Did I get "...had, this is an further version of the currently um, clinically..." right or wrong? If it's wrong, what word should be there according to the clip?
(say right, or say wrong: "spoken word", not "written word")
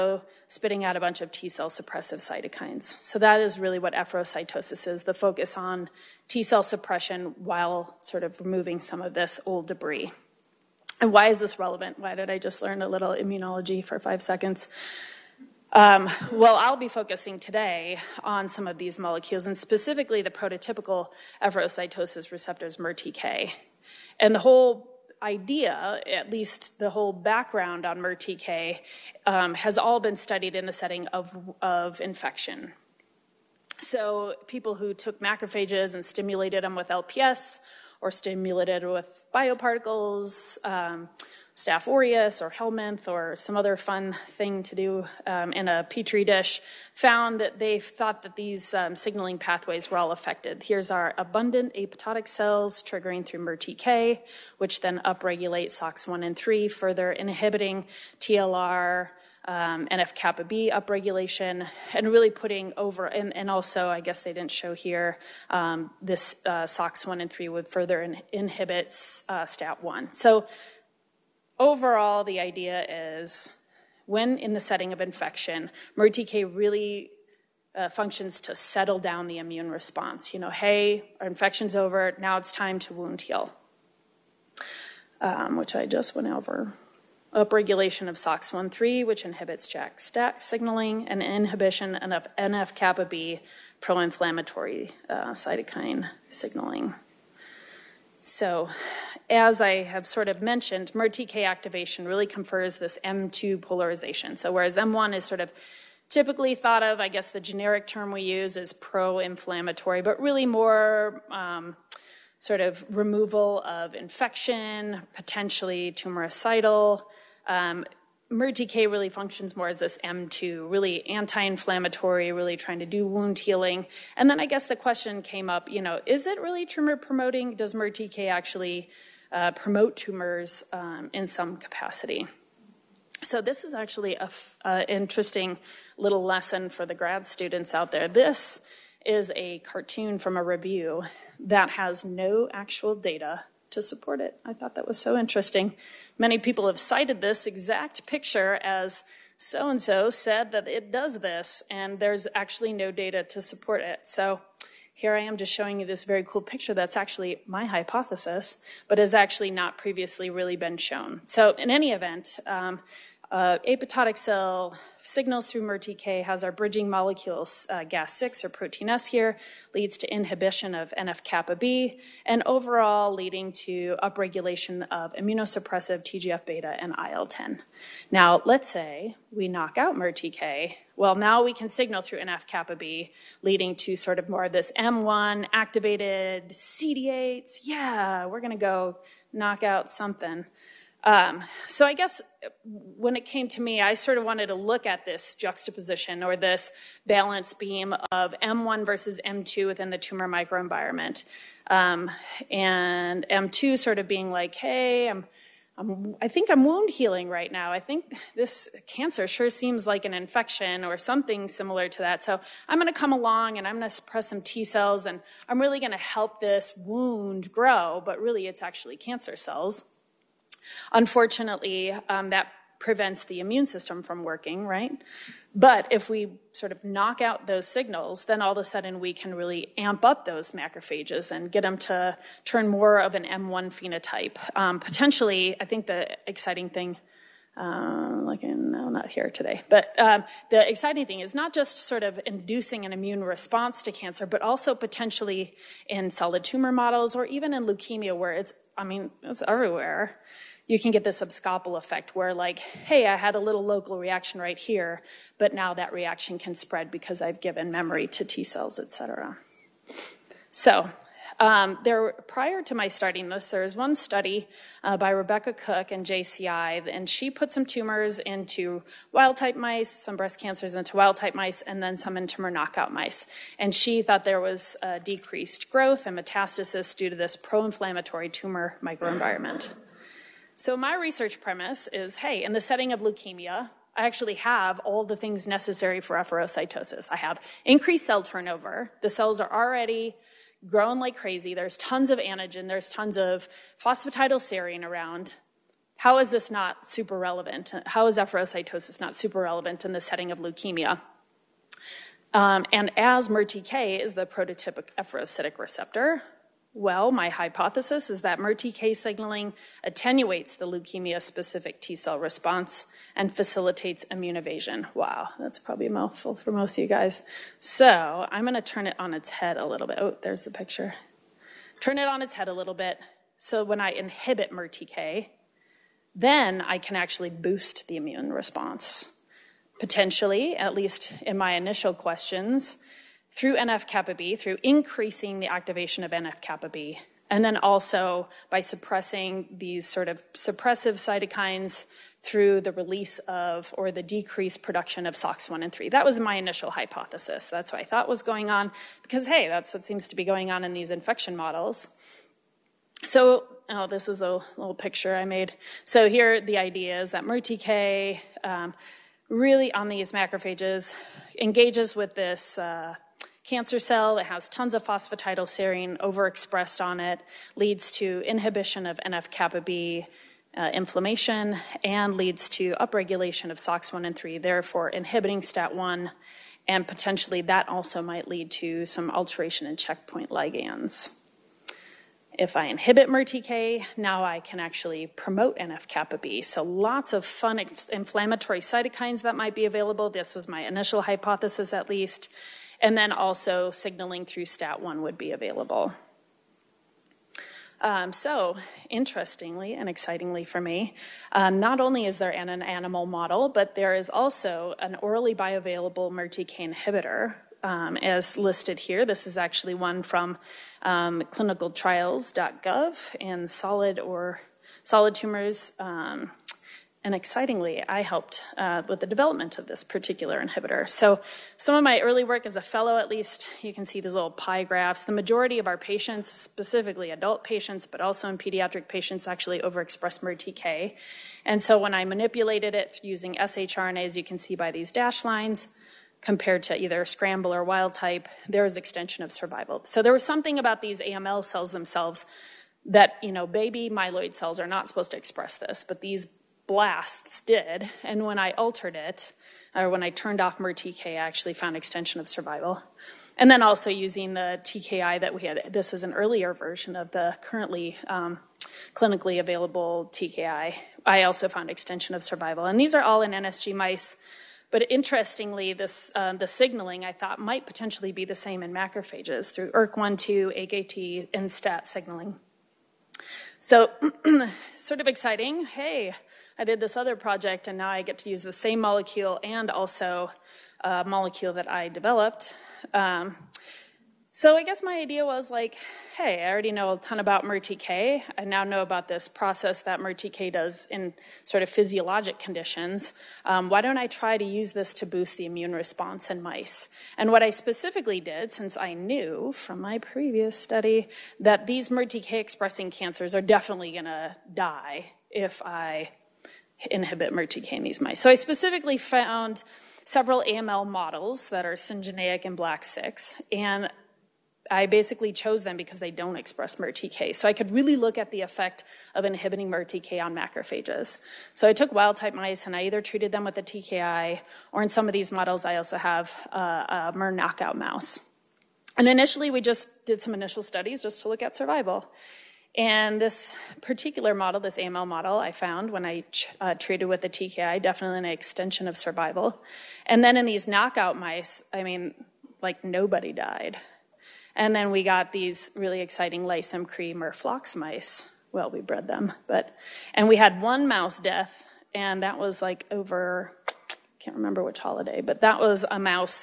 wrong: "earlier", not "further".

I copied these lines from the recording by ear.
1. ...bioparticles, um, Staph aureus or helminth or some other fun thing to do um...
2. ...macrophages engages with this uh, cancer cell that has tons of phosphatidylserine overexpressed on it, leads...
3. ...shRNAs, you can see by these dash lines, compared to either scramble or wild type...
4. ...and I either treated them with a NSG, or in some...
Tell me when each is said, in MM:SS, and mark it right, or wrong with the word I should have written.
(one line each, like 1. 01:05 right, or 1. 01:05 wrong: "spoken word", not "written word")
1. 00:39 right
2. 06:00 right
3. 07:13 right
4. 08:42 wrong: "TKI", not "NSG".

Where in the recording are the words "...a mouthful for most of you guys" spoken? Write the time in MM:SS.
05:15.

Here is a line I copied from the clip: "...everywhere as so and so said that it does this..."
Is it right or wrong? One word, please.
wrong.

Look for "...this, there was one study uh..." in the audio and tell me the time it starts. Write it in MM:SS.
04:23.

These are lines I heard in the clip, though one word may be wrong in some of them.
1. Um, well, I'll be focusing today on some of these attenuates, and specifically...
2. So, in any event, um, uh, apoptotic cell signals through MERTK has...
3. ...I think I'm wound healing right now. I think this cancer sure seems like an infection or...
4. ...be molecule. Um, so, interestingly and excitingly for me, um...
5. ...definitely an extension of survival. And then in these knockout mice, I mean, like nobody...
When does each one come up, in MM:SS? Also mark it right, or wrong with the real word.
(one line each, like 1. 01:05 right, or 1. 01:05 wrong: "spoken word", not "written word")
1. 00:15 wrong: "molecules", not "attenuates"
2. 02:41 right
3. 03:26 right
4. 06:35 wrong: "available", not "molecule"
5. 08:57 right.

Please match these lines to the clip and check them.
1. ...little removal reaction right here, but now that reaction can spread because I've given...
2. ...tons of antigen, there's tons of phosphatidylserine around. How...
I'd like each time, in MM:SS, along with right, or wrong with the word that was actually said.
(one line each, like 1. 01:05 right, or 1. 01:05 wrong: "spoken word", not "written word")
1. 04:13 wrong: "local", not "removal"
2. 04:51 right.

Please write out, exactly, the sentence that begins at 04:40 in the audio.
So, my research premise is hey, in the setting of leukemia, I actually have all the things necessary for efferocytosis.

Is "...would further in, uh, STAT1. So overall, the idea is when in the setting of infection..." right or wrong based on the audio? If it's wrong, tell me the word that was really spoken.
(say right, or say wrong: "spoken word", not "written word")
right.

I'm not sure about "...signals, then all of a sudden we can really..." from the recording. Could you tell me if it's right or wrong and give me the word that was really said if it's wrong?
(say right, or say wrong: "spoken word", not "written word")
right.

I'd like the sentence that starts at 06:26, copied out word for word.
So lots of fun inflammatory cytokines that might be available.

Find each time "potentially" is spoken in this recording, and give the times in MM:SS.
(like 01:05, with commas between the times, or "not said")
01:55, 03:54, 04:04, 05:29, 06:16, 07:47.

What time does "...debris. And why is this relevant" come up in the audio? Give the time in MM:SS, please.
00:09.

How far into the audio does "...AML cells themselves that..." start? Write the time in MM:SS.
07:20.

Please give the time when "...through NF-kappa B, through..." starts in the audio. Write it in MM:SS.
05:33.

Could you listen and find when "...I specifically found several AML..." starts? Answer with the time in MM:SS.
08:28.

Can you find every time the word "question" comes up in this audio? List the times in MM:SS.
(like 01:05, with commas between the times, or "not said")
02:04, 05:31.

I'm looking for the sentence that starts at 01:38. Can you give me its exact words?
So, as I have sort of mentioned, MERTK activation really confers this M2 polarization.